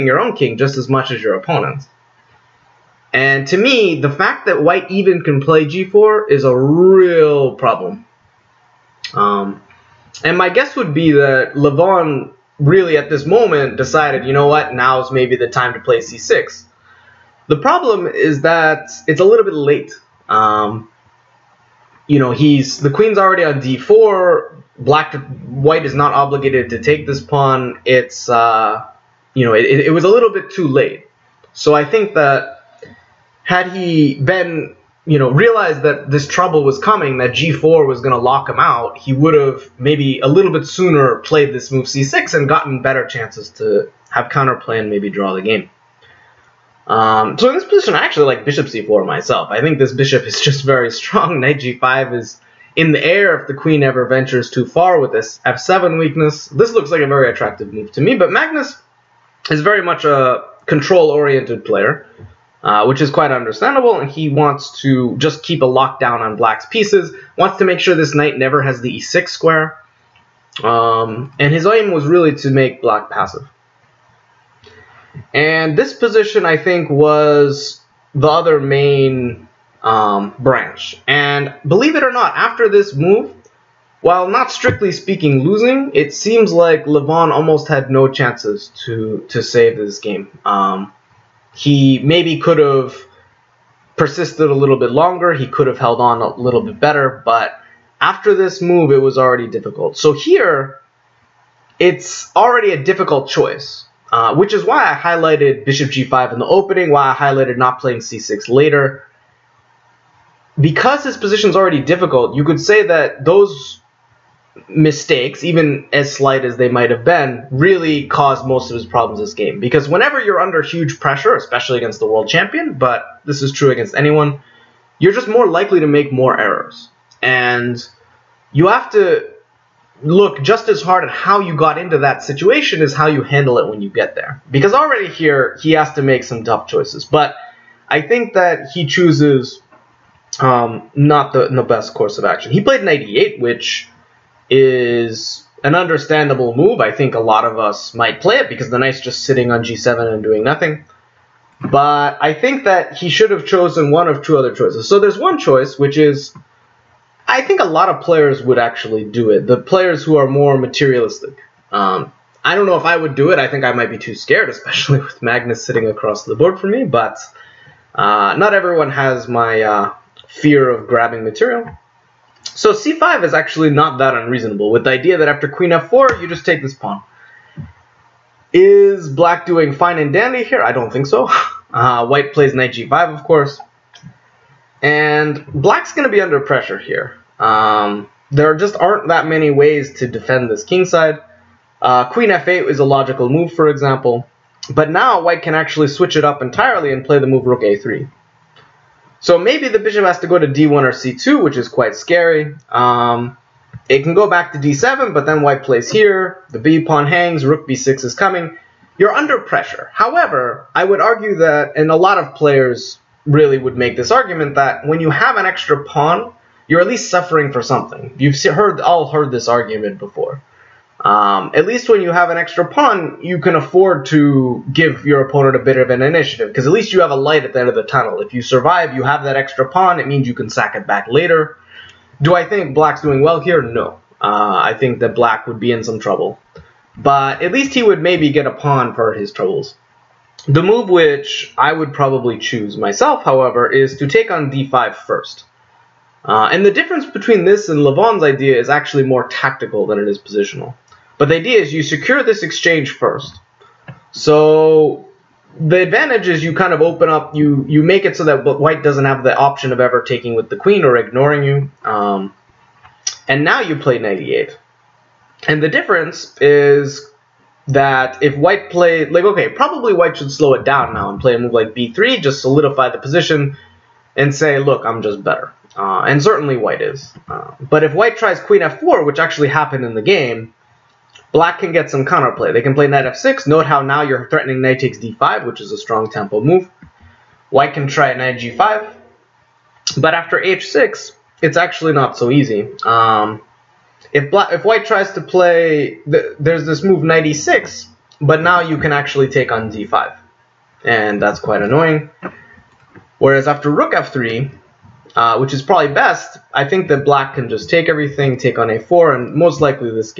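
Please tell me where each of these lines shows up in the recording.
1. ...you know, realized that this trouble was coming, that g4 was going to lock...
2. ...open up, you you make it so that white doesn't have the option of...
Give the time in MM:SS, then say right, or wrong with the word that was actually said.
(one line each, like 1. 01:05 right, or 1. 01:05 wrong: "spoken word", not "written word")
1. 00:35 right
2. 04:16 right.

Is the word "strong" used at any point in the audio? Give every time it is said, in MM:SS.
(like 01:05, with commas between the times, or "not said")
00:50, 04:45.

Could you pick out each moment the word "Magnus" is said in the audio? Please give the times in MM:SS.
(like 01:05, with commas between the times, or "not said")
00:58, 02:45.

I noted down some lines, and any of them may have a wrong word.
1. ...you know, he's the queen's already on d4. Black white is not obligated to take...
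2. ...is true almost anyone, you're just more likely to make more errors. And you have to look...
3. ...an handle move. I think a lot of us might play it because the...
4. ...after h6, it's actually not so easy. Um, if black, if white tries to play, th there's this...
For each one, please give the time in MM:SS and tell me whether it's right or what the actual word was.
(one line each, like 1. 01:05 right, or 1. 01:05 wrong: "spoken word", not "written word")
1. 00:22 right
2. 02:03 wrong: "against", not "almost"
3. 02:25 wrong: "understandable", not "handle"
4. 04:50 right.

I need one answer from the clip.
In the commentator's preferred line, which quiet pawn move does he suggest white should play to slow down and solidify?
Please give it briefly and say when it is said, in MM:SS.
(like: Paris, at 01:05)
b3, at 04:31.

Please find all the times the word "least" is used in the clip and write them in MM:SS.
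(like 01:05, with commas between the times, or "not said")
03:36, 03:41, 03:46, 03:57.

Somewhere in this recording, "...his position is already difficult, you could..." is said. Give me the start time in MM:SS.
01:51.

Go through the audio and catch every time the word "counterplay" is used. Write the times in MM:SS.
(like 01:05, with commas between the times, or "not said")
00:44, 04:42.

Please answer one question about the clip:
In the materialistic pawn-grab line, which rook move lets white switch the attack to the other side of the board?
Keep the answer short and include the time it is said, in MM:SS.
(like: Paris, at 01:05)
rook a3, at 03:17.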